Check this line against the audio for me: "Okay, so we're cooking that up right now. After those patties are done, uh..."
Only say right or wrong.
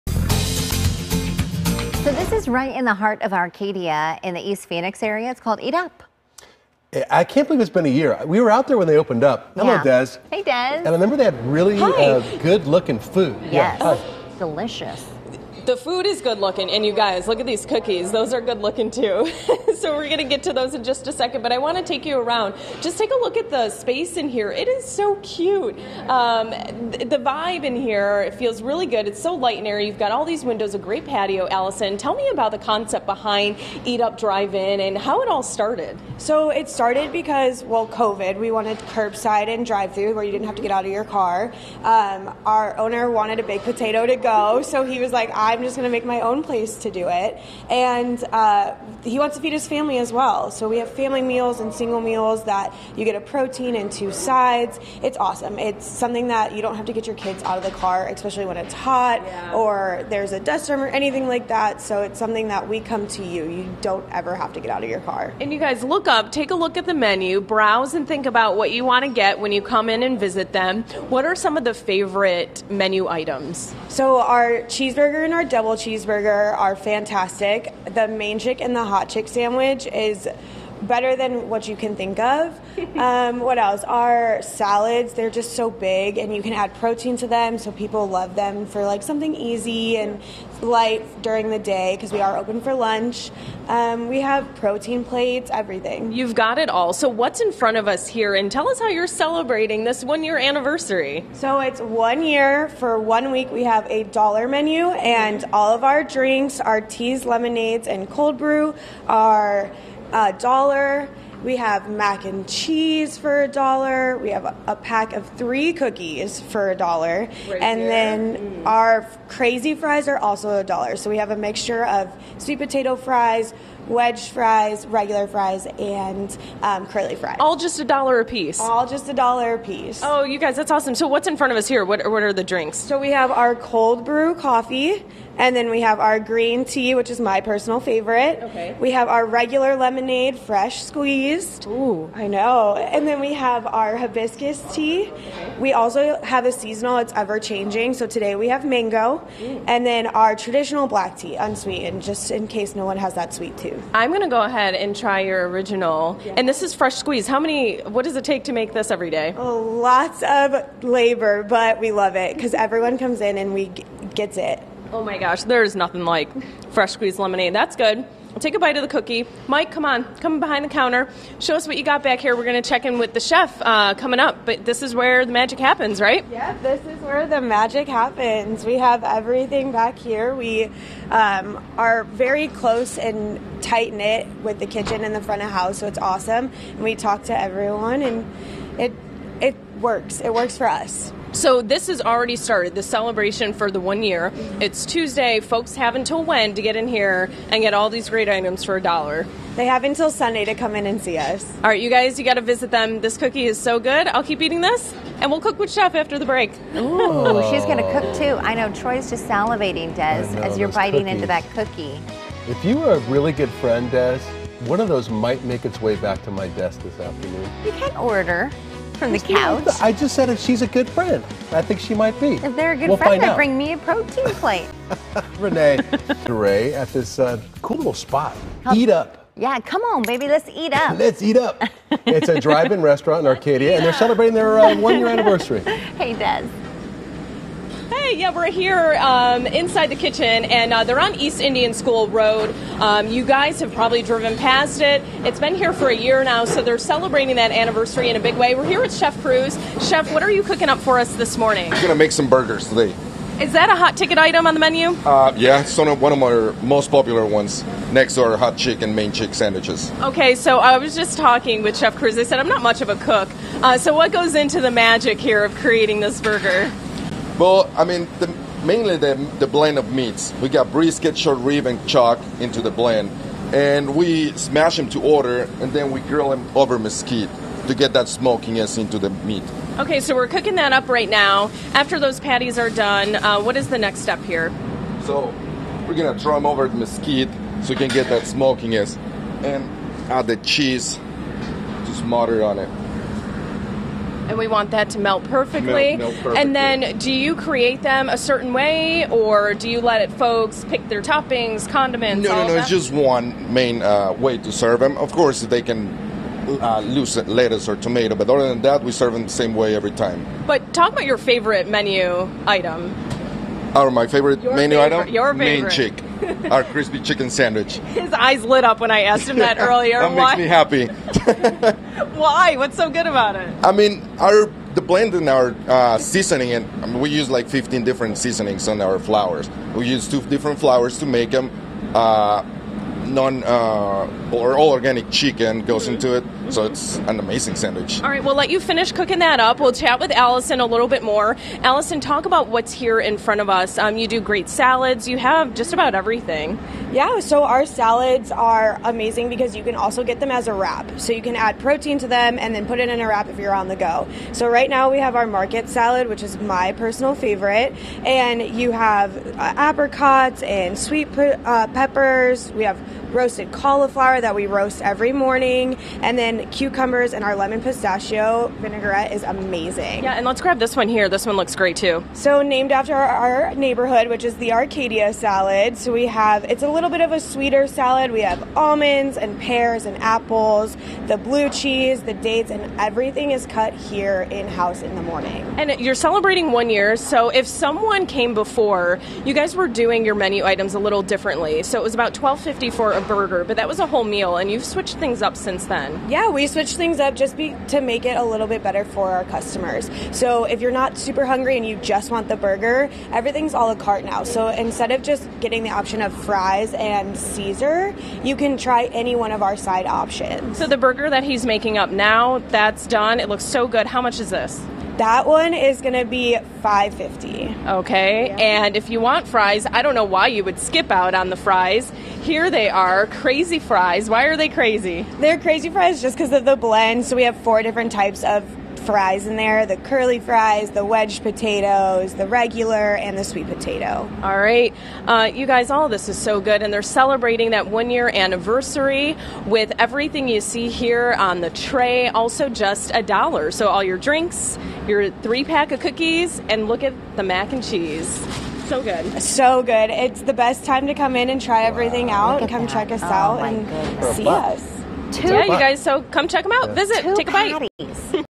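right.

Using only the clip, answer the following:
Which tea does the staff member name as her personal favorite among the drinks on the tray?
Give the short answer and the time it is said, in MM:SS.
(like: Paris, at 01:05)
Green tea, at 02:16.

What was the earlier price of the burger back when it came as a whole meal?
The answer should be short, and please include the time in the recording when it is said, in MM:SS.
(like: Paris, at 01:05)
$12.50, at 06:32.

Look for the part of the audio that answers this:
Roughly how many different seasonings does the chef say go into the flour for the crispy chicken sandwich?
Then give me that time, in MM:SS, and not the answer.
05:27.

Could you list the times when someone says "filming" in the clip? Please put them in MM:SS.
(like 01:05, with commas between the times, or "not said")
not said.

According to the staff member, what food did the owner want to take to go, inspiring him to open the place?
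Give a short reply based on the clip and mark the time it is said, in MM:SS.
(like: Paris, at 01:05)
Baked potato, at 00:43.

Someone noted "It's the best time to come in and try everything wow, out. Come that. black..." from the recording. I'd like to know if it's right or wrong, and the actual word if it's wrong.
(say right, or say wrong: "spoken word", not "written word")
wrong: "check", not "black".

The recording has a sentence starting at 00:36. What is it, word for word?
So it started because, well, COVID.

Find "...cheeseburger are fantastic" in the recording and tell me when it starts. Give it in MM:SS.
01:15.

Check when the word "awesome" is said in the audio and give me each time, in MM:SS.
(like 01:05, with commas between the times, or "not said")
00:55, 02:10, 03:05.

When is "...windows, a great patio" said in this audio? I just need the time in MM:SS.
00:30.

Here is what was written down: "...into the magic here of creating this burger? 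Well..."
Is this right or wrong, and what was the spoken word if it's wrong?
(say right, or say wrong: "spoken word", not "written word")
right.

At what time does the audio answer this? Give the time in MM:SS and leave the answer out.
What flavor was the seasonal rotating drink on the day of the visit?
02:28.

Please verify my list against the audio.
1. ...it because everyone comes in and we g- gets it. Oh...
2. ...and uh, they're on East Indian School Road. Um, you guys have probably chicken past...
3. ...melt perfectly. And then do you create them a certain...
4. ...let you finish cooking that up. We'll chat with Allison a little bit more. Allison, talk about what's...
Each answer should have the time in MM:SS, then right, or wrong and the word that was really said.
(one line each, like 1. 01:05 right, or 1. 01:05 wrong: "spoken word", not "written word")
1. 02:42 right
2. 04:00 wrong: "driven", not "chicken"
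3. 04:55 right
4. 05:38 right.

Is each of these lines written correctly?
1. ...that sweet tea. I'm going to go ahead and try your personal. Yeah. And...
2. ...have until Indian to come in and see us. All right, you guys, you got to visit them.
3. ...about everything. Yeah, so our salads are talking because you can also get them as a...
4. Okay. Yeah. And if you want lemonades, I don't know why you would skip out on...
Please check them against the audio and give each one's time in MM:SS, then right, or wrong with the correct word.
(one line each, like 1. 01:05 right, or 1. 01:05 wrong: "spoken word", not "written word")
1. 02:33 wrong: "original", not "personal"
2. 03:19 wrong: "Sunday", not "Indian"
3. 05:45 wrong: "amazing", not "talking"
4. 06:57 wrong: "fries", not "lemonades".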